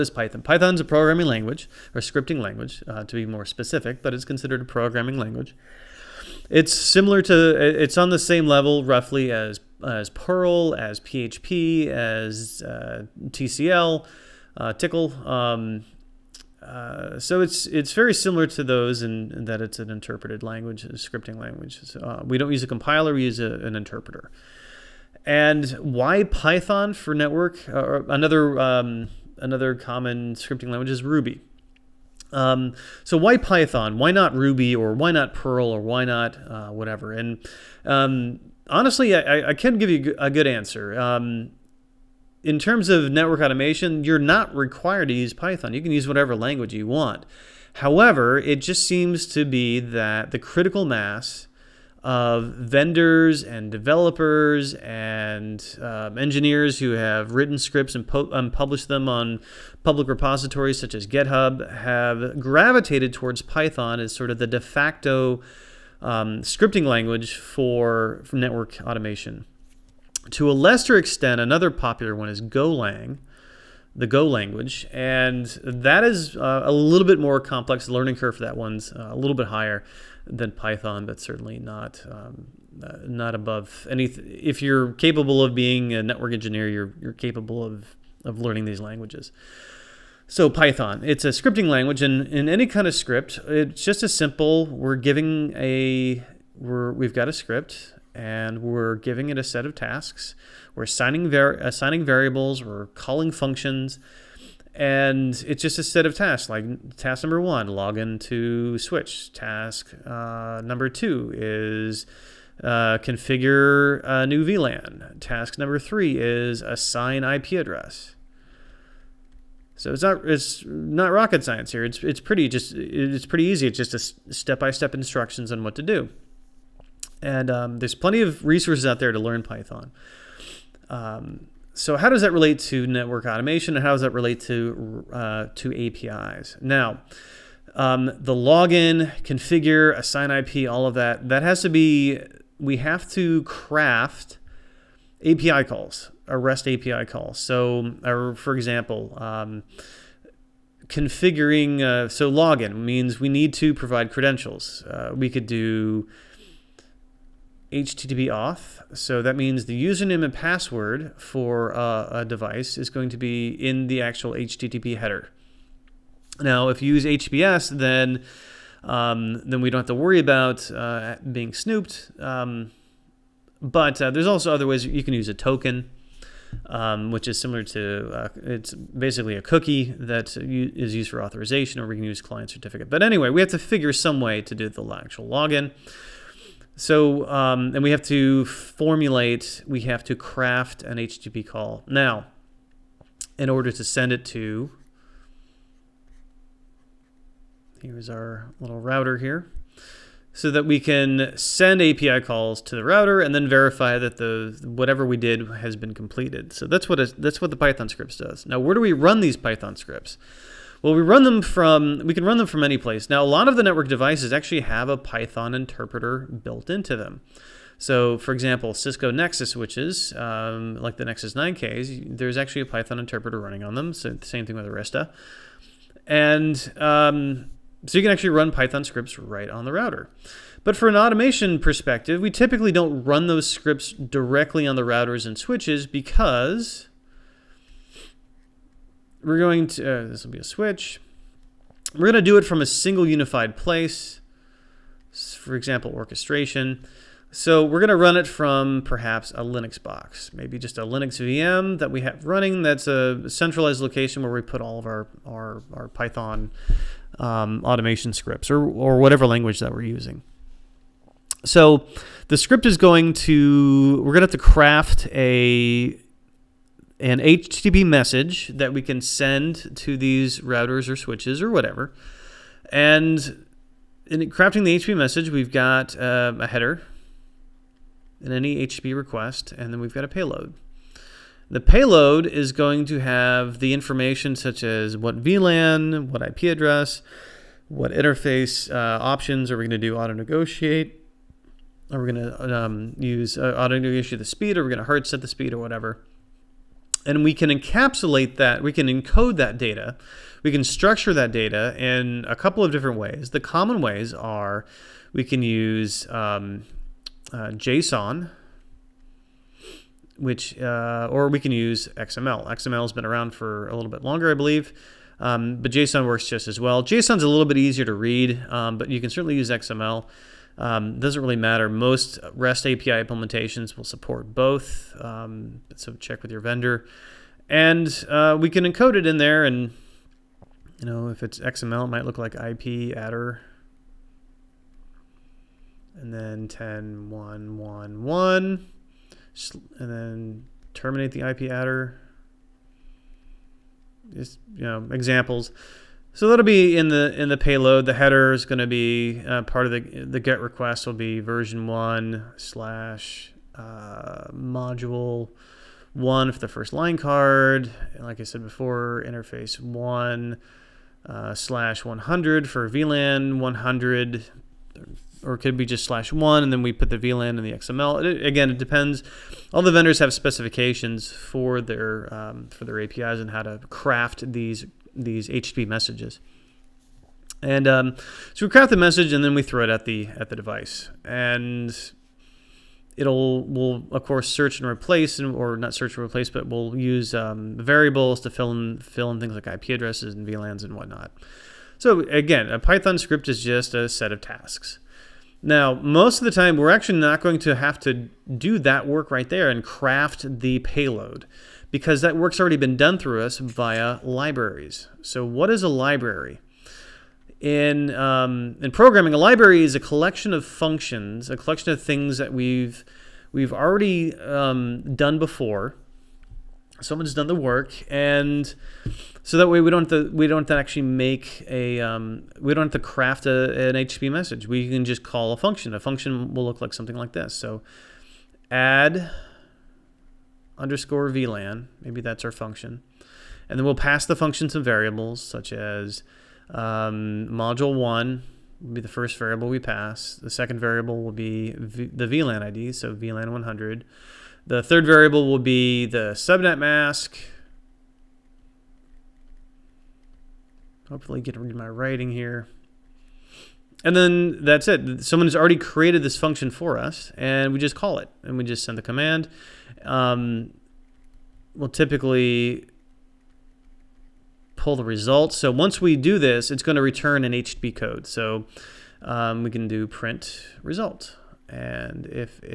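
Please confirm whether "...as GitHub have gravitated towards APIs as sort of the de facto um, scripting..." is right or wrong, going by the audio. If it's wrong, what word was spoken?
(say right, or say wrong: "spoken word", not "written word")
wrong: "Python", not "APIs".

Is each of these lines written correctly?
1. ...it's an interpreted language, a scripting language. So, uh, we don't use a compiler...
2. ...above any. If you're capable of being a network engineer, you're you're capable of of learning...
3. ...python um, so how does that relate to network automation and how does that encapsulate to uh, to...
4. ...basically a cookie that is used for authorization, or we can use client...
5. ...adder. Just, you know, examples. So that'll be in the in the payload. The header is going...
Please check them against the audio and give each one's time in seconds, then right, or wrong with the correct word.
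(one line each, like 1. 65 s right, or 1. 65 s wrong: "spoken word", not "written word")
1. 19 s right
2. 83 s right
3. 129 s wrong: "relate", not "encapsulate"
4. 178 s right
5. 341 s right.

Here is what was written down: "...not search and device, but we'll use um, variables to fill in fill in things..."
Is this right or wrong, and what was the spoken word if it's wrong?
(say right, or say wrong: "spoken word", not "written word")
wrong: "replace", not "device".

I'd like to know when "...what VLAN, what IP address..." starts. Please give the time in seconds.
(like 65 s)
284 s.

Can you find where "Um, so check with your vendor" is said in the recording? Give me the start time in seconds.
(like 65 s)
325 s.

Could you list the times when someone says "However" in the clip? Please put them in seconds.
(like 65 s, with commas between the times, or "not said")
47 s.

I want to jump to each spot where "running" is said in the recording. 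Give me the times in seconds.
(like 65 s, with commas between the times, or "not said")
223 s, 252 s.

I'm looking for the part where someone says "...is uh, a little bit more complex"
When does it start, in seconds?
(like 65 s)
76 s.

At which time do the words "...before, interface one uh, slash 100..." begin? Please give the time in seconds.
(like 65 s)
358 s.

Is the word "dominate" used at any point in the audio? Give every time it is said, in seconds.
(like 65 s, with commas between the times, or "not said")
not said.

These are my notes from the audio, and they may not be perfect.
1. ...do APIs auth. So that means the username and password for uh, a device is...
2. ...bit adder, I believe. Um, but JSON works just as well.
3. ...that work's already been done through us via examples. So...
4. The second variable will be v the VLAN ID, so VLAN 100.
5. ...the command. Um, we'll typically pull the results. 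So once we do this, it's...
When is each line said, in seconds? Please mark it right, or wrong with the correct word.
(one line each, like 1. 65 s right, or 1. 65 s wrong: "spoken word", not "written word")
1. 155 s wrong: "HTTP", not "APIs"
2. 313 s wrong: "longer", not "adder"
3. 401 s wrong: "libraries", not "examples"
4. 440 s right
5. 458 s right.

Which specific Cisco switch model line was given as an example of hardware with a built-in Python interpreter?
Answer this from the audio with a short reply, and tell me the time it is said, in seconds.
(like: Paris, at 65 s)
Nexus 9Ks, at 221 s.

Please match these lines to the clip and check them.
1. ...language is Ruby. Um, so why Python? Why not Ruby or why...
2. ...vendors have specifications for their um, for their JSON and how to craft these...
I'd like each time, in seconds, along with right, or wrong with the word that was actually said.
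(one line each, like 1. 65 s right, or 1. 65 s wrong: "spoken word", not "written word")
1. 30 s right
2. 369 s wrong: "APIs", not "JSON".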